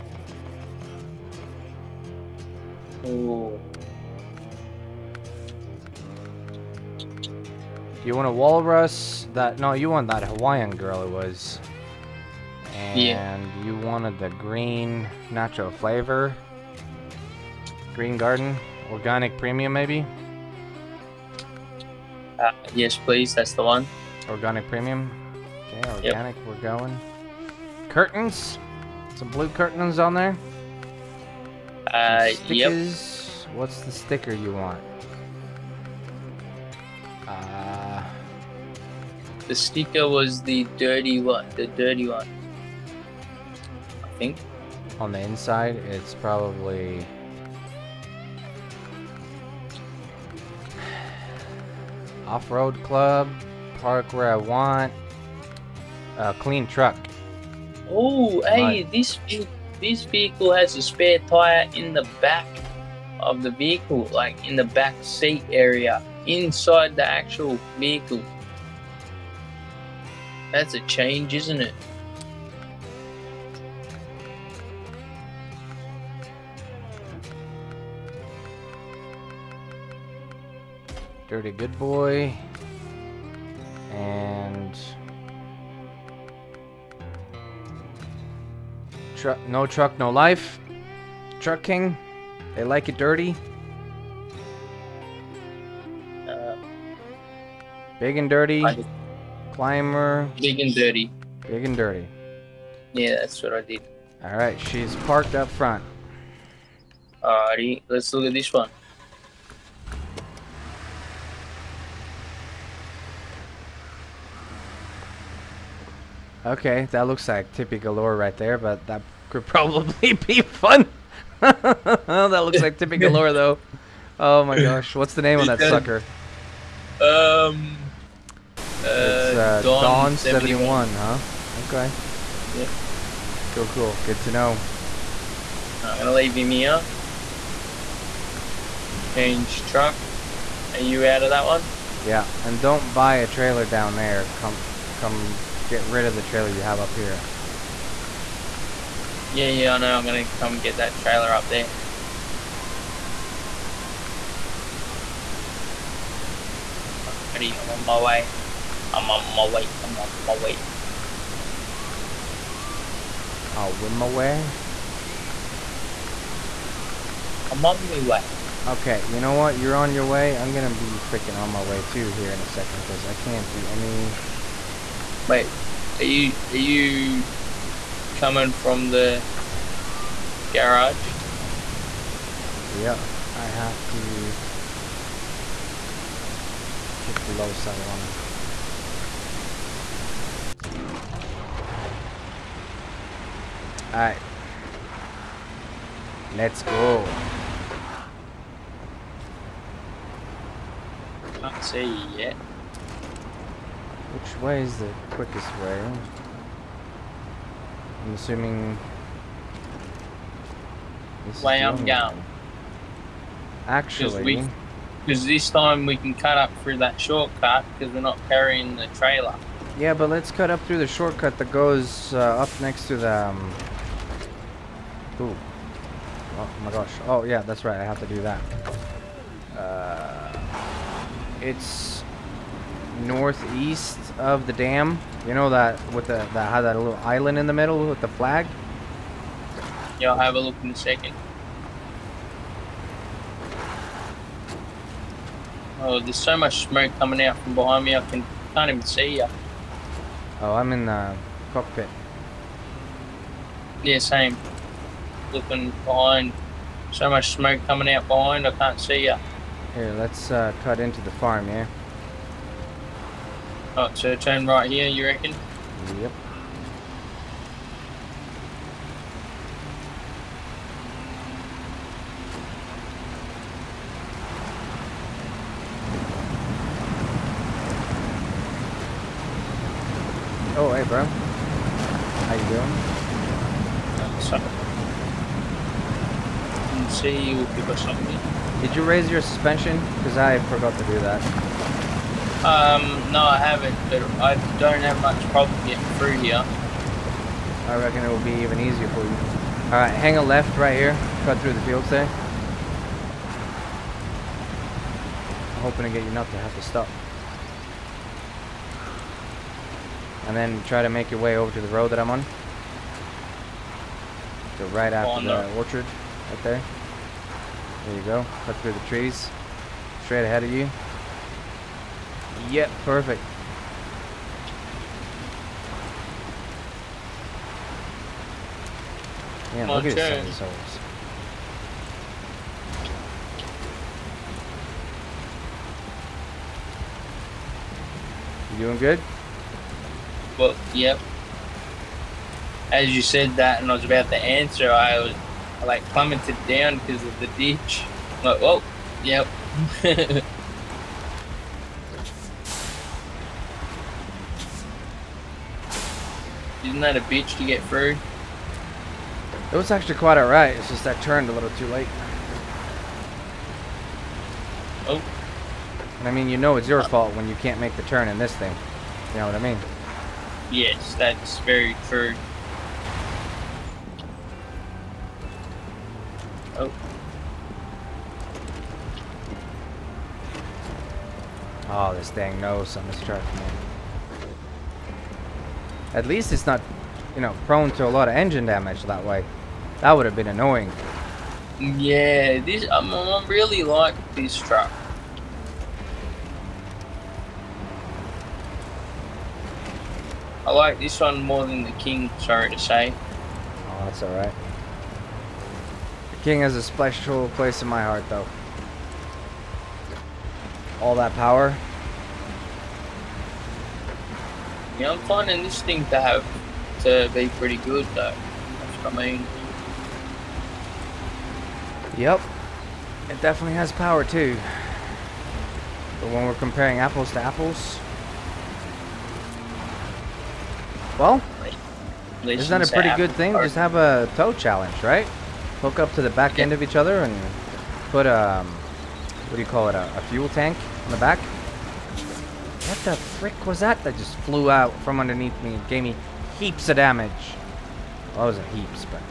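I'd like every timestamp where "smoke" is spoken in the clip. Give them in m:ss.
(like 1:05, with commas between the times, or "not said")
4:06, 4:17.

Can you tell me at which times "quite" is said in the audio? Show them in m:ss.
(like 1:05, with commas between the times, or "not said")
5:59.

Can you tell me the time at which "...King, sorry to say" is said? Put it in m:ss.
6:41.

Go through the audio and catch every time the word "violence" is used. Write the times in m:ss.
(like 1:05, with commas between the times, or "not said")
not said.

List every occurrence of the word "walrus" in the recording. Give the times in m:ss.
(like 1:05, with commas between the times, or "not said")
0:08.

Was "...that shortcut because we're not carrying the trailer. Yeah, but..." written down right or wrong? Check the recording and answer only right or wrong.
right.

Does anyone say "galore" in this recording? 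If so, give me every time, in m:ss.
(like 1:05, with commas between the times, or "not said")
1:57, 2:03.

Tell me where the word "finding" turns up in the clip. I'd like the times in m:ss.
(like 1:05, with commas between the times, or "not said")
6:55.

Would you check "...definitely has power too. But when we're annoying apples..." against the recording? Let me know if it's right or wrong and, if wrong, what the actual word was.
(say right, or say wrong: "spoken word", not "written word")
wrong: "comparing", not "annoying".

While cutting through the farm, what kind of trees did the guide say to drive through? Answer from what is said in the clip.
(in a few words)
Orchard.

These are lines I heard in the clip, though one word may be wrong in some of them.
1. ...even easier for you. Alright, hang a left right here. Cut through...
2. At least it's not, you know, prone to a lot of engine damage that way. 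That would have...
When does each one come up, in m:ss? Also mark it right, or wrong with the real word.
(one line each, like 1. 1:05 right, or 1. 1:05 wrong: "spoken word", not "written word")
1. 4:58 right
2. 6:25 right.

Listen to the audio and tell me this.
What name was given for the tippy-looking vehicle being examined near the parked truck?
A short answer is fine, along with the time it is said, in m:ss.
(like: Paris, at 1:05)
Don 71, at 2:09.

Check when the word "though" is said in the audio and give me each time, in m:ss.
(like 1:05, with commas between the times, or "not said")
2:03, 6:48, 6:57.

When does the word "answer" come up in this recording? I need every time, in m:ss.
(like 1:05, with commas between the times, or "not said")
5:44.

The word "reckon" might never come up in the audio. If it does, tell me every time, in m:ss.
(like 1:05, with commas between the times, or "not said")
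4:25, 4:57.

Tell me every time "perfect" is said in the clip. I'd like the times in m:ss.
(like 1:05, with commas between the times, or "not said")
5:22.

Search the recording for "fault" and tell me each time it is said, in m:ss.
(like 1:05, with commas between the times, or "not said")
6:06.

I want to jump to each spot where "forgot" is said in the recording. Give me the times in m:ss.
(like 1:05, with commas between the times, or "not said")
4:50.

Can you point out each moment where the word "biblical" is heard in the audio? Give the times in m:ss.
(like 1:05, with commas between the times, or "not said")
not said.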